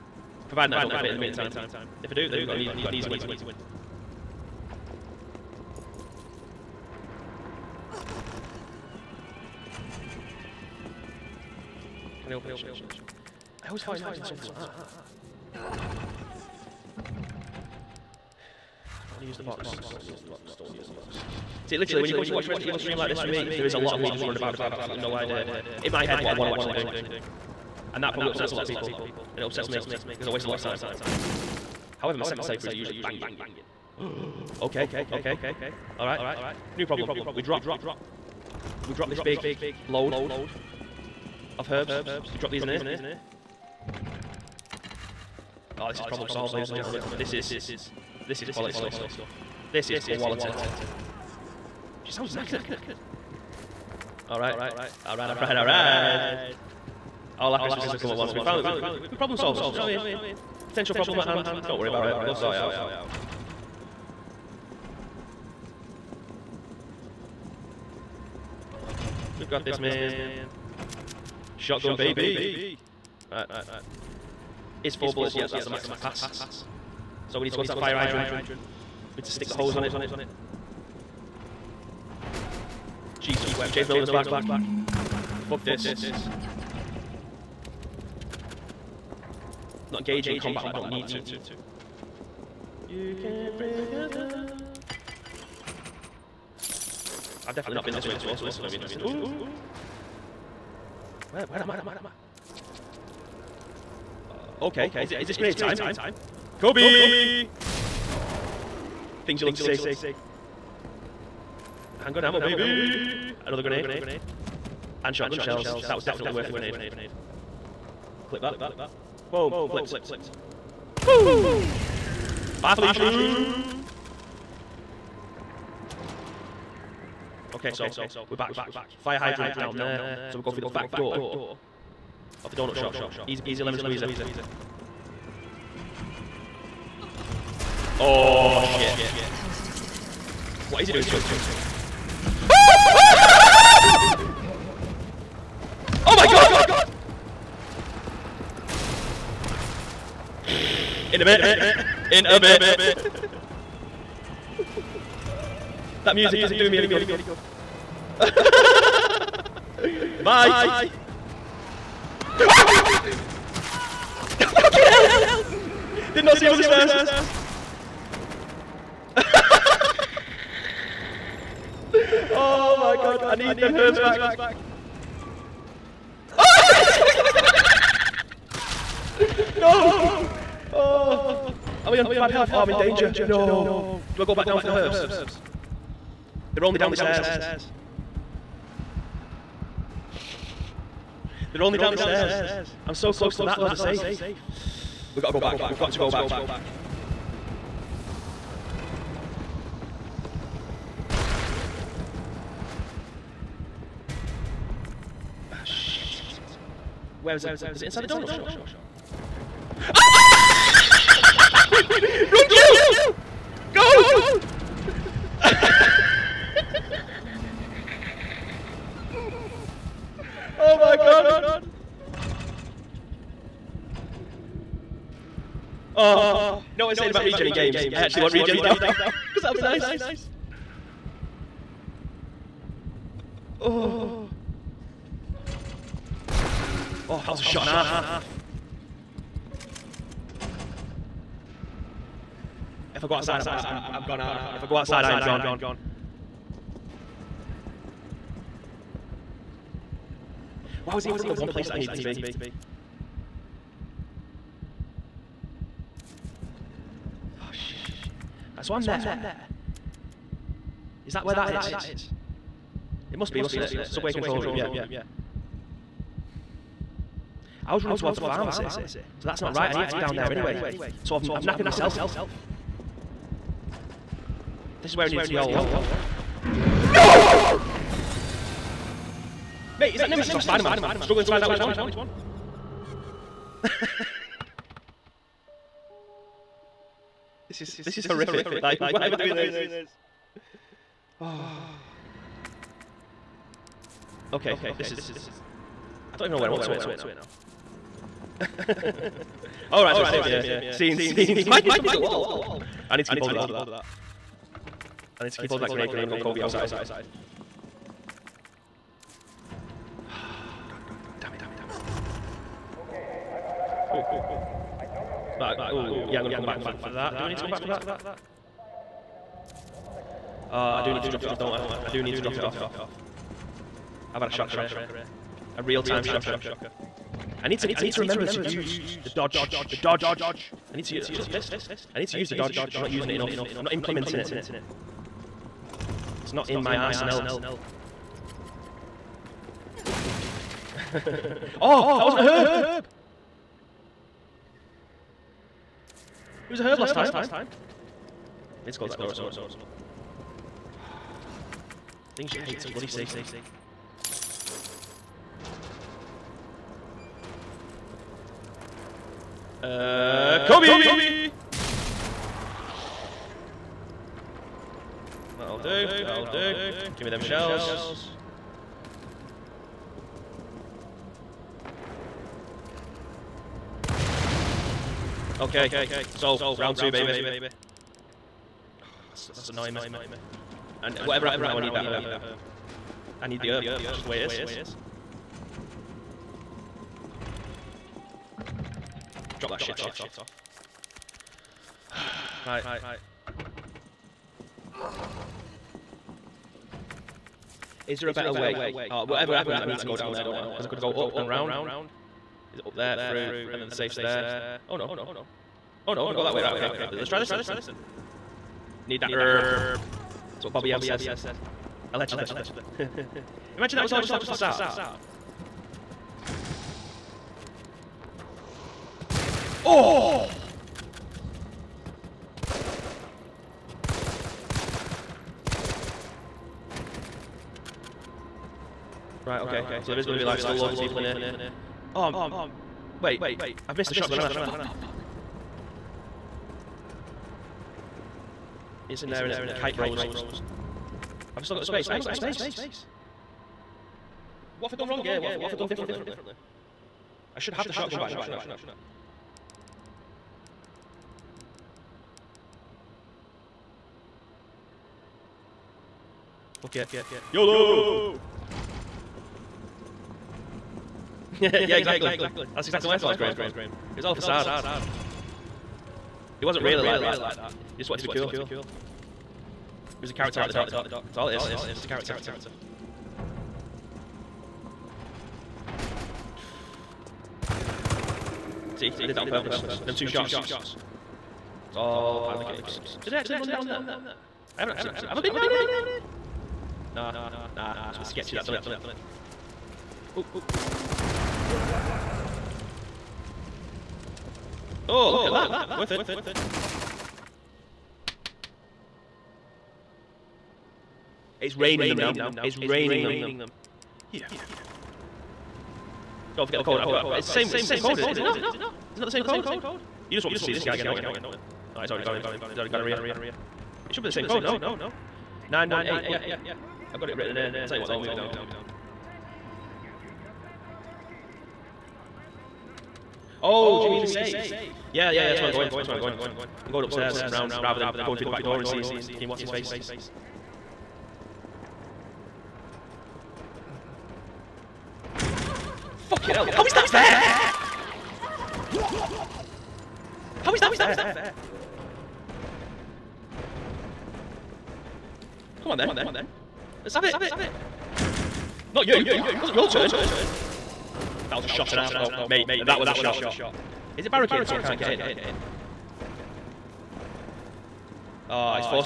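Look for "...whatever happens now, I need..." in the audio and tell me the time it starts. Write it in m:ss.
6:21.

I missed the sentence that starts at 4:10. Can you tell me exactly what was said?
Why was he in front of the one place that I needed to be?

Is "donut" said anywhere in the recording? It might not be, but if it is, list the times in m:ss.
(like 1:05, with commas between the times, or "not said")
2:12, 3:28.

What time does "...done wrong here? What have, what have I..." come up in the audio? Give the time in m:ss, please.
7:24.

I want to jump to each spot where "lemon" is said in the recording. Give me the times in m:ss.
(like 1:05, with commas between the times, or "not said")
2:13.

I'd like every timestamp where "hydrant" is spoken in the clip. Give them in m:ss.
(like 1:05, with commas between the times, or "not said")
1:17, 2:09.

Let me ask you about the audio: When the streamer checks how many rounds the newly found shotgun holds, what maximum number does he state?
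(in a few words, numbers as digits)
4.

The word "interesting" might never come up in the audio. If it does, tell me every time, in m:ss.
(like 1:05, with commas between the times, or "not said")
1:38.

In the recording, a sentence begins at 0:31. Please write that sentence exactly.
However, my second playthroughs are usually banging.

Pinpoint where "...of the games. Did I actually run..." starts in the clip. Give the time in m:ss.
8:02.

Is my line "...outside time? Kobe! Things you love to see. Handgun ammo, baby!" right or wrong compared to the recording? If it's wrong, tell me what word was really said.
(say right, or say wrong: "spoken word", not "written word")
wrong: "grenade", not "outside".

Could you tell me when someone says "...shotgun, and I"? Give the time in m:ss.
7:13.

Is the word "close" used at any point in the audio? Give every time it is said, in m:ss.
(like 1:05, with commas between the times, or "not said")
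3:13, 5:48.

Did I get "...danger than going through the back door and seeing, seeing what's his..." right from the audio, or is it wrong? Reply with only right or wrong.
wrong.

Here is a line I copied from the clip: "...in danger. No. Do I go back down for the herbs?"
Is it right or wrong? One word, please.
right.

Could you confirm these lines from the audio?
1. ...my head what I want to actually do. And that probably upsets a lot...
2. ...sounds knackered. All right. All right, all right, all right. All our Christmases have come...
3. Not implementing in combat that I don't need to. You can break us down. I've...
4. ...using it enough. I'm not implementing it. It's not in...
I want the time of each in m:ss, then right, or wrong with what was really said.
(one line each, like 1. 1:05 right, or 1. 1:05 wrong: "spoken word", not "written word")
1. 0:25 right
2. 0:52 right
3. 1:29 wrong: "engaging", not "implementing"
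4. 5:32 right.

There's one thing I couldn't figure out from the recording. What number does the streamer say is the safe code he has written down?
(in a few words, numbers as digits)
918.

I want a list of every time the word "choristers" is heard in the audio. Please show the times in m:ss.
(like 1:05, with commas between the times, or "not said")
not said.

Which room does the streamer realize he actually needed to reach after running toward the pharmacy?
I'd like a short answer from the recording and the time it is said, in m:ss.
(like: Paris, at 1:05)
Subway control room, at 4:23.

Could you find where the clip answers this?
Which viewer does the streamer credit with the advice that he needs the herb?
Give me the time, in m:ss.
6:50.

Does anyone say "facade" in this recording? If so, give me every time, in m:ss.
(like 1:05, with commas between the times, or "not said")
6:54, 7:44.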